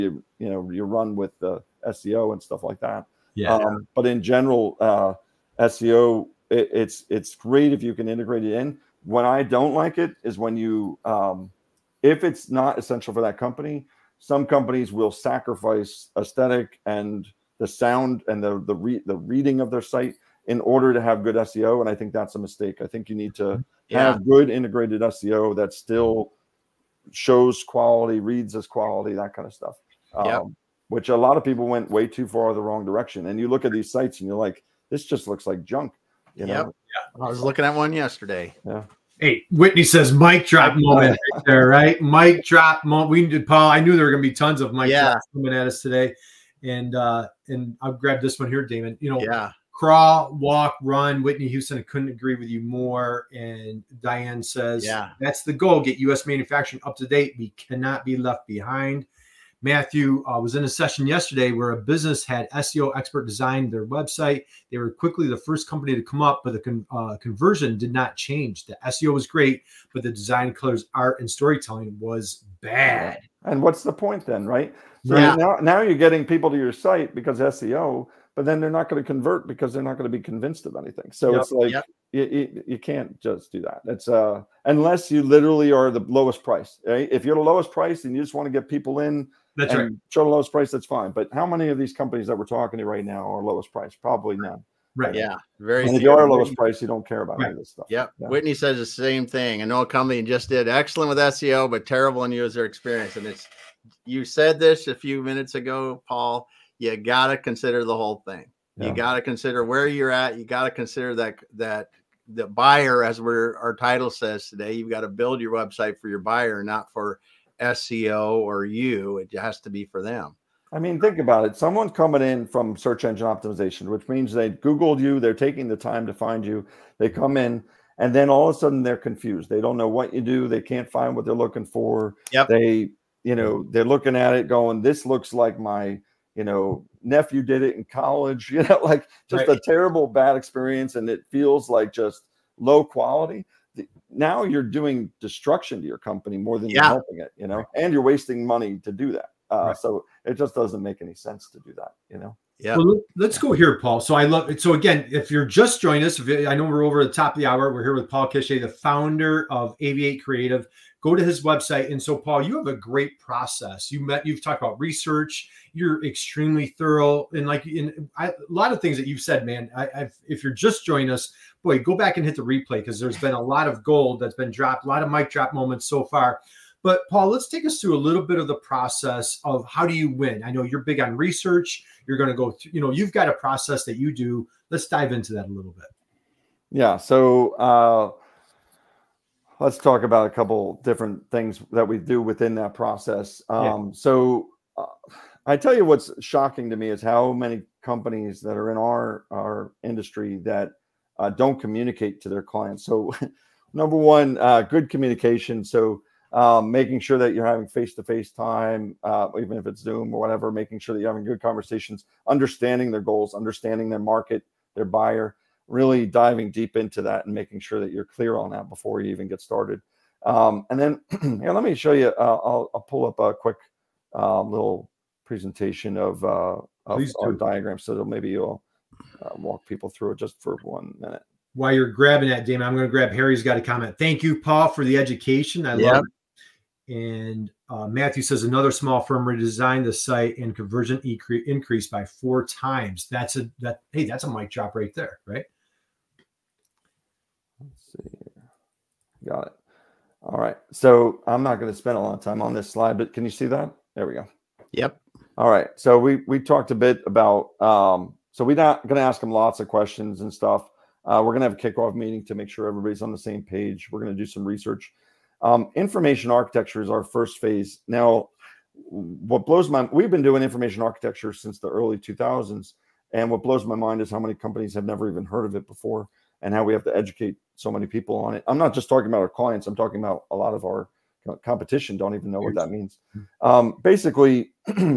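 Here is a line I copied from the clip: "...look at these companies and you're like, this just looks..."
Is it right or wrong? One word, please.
wrong.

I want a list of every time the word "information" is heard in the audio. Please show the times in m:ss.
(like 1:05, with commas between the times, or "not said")
4:25, 4:30.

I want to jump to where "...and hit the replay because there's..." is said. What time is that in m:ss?
2:52.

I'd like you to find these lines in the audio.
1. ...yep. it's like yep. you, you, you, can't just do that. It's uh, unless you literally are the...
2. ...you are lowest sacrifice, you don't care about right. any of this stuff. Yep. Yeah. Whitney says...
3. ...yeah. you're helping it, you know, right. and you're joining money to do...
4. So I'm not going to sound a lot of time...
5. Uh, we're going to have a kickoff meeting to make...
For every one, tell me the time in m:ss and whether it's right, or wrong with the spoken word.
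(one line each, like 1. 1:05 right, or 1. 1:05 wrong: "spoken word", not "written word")
1. 1:21 right
2. 1:36 wrong: "price", not "sacrifice"
3. 2:26 wrong: "wasting", not "joining"
4. 4:10 wrong: "spend", not "sound"
5. 4:21 right.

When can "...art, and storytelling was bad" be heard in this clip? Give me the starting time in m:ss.
1:10.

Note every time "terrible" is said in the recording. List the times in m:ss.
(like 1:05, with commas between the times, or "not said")
1:41, 2:19.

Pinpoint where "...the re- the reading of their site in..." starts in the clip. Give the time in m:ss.
0:18.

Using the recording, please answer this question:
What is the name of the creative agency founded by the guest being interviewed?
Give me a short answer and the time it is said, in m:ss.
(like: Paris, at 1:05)
Aviate Creative, at 2:39.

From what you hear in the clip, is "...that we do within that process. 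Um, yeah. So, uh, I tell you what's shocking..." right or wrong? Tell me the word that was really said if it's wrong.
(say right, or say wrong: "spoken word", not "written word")
right.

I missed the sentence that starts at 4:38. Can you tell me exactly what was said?
I'm not just talking about our clients.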